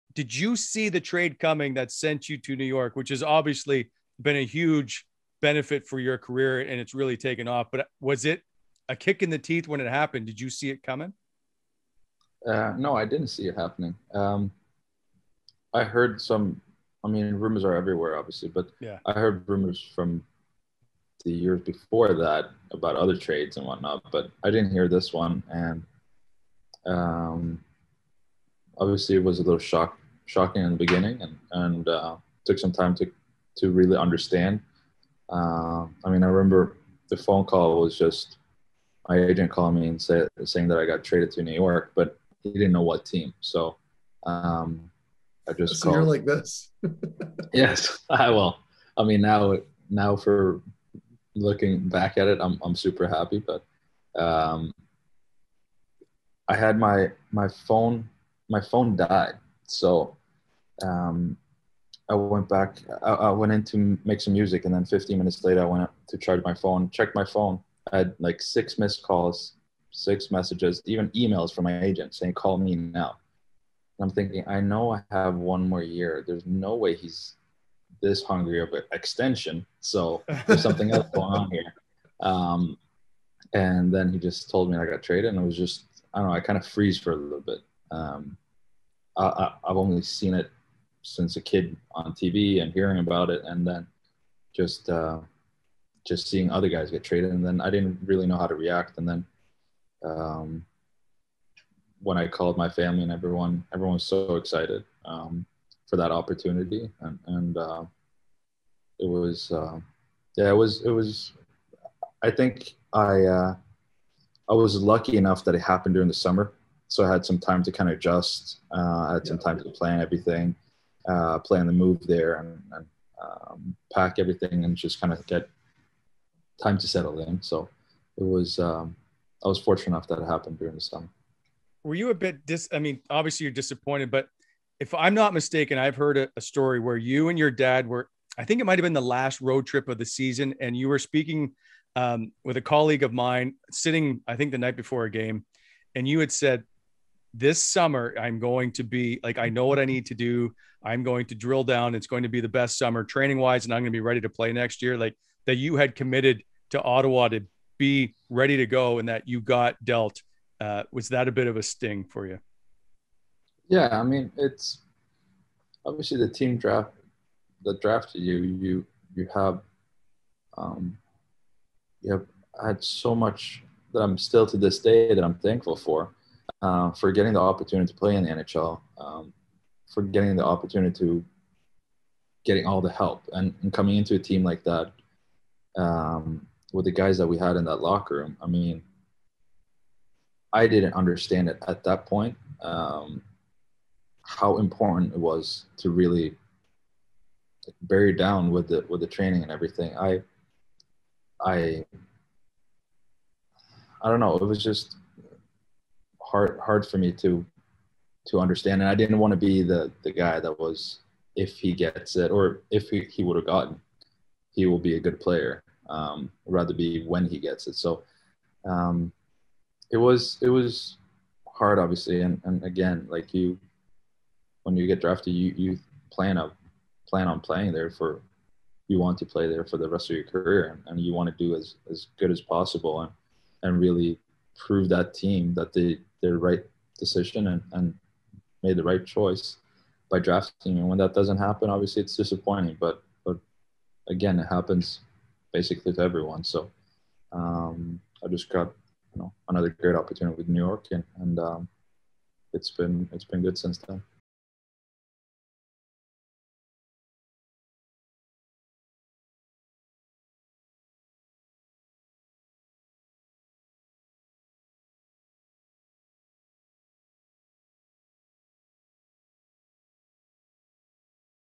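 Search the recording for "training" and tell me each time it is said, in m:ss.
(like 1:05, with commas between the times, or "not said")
2:33, 3:19.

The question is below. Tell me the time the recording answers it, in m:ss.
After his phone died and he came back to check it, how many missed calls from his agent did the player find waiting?
1:08.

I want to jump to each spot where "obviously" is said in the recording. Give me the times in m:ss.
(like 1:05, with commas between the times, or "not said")
0:03, 0:18, 0:28, 2:13, 2:45, 3:41, 4:01.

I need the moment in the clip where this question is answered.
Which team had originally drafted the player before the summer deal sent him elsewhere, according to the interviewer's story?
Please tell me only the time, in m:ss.
2:36.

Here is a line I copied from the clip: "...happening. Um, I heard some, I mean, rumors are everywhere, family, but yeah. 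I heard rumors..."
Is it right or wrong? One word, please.
wrong.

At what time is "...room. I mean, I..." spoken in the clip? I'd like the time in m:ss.
3:08.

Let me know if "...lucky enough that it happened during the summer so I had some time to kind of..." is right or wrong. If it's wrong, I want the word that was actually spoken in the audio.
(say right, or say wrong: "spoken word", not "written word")
right.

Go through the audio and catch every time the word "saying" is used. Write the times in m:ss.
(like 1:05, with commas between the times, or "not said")
0:40, 1:12.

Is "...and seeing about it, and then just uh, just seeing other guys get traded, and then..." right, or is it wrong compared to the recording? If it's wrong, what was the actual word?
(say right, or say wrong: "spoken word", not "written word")
wrong: "hearing", not "seeing".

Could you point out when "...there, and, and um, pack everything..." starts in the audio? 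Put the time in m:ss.
2:02.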